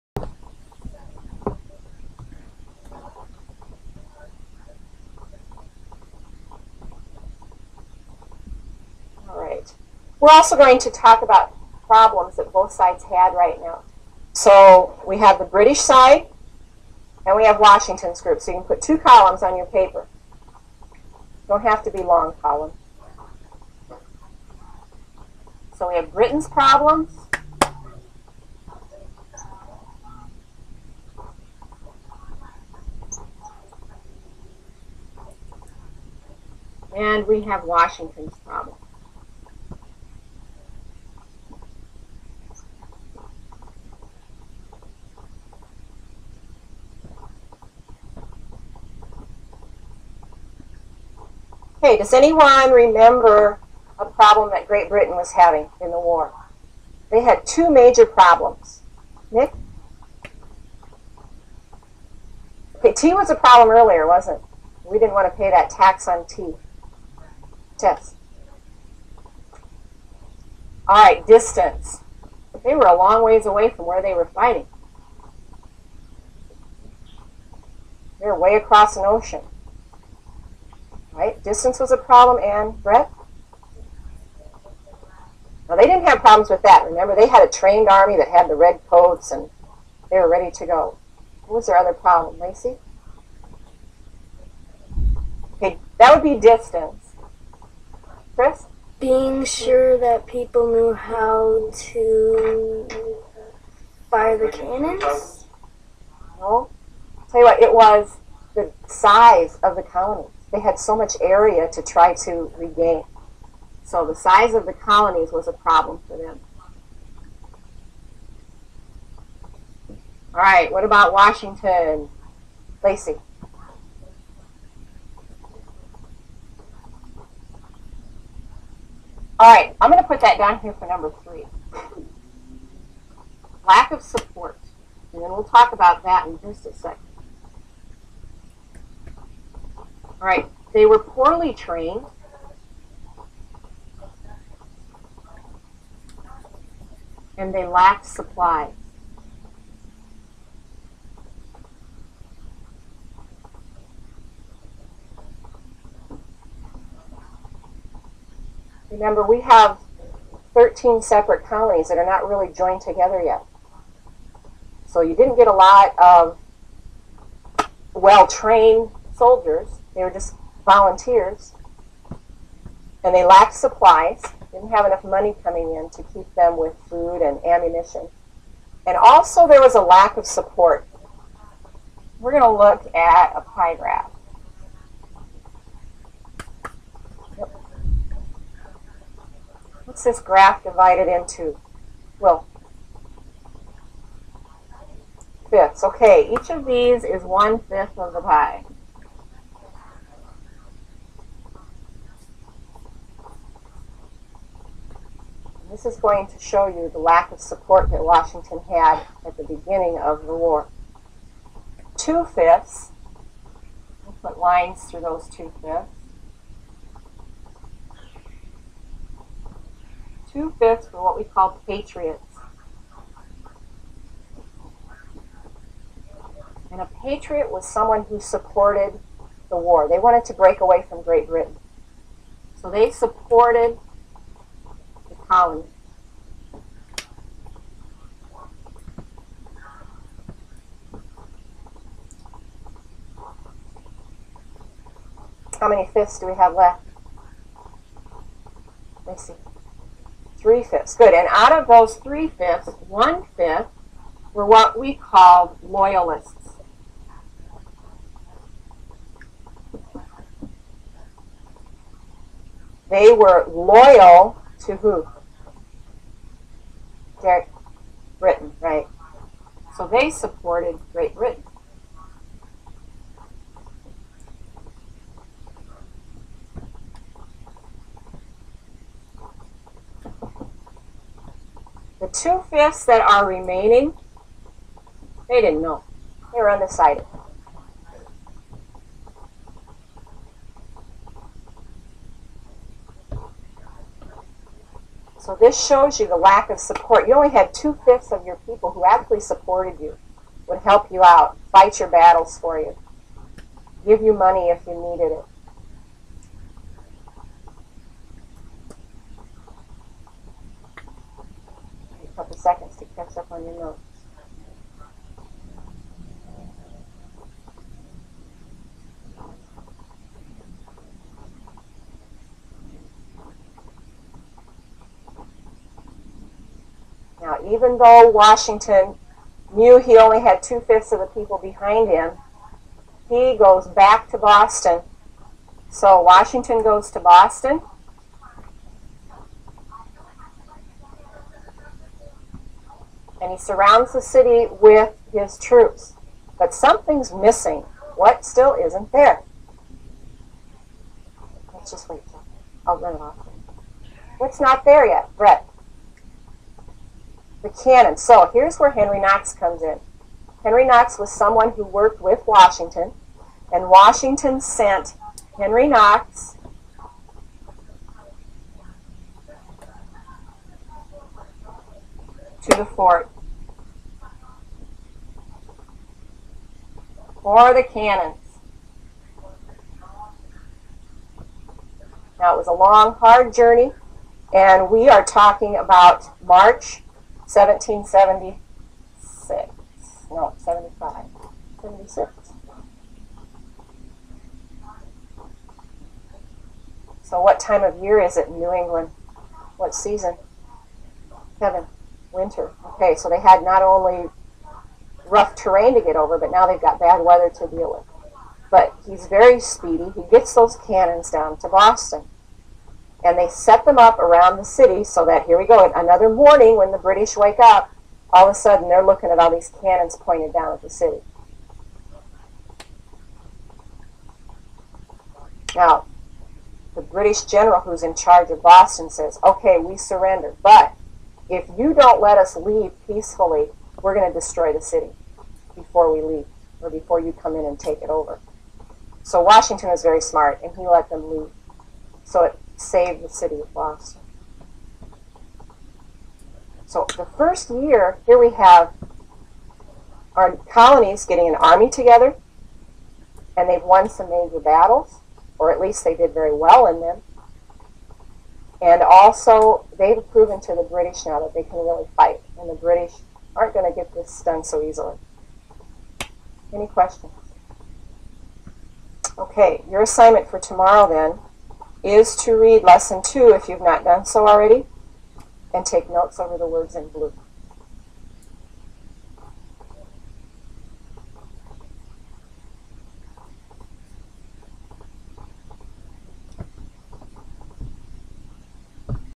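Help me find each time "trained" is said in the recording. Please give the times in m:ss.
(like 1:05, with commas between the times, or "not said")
1:27, 2:21, 2:47.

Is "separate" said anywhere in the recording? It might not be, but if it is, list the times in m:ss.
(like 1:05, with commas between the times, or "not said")
2:41.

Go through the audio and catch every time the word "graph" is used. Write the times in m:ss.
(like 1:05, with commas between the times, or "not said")
3:03, 3:10.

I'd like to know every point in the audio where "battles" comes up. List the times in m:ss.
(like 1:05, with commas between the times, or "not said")
5:01, 7:34.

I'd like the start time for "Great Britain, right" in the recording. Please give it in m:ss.
4:27.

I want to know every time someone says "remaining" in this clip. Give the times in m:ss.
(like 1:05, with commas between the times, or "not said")
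4:43.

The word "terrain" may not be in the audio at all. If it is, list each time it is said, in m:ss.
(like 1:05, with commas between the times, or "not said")
6:45.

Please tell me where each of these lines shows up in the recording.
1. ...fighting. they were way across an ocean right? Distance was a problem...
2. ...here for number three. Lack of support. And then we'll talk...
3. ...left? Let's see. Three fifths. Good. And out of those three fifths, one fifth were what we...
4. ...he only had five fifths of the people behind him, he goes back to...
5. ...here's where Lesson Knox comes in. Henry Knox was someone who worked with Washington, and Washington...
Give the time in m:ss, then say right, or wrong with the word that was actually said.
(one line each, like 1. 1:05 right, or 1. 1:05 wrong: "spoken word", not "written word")
1. 1:14 right
2. 2:10 right
3. 4:06 right
4. 5:29 wrong: "two", not "five"
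5. 5:58 wrong: "Henry", not "Lesson".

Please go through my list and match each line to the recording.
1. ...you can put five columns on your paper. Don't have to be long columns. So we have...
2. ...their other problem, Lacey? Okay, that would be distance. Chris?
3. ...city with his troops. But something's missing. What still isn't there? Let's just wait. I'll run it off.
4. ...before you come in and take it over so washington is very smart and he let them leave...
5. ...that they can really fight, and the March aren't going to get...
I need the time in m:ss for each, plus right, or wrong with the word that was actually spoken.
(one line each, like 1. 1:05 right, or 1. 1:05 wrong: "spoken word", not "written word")
1. 0:18 wrong: "two", not "five"
2. 1:31 right
3. 5:44 right
4. 7:16 right
5. 7:41 wrong: "British", not "March".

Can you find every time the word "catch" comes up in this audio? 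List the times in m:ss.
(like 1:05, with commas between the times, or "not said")
5:12.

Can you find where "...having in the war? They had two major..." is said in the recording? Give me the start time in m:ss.
0:55.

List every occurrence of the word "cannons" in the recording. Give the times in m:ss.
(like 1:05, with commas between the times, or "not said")
1:44, 5:57, 6:17, 6:50, 6:59.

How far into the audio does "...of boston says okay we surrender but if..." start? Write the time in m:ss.
7:08.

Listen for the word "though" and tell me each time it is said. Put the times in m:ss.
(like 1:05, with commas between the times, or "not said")
5:27.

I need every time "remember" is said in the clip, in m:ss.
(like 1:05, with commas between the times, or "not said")
0:52, 1:26, 2:38.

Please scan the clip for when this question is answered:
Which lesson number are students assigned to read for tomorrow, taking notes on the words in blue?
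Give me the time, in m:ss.
7:52.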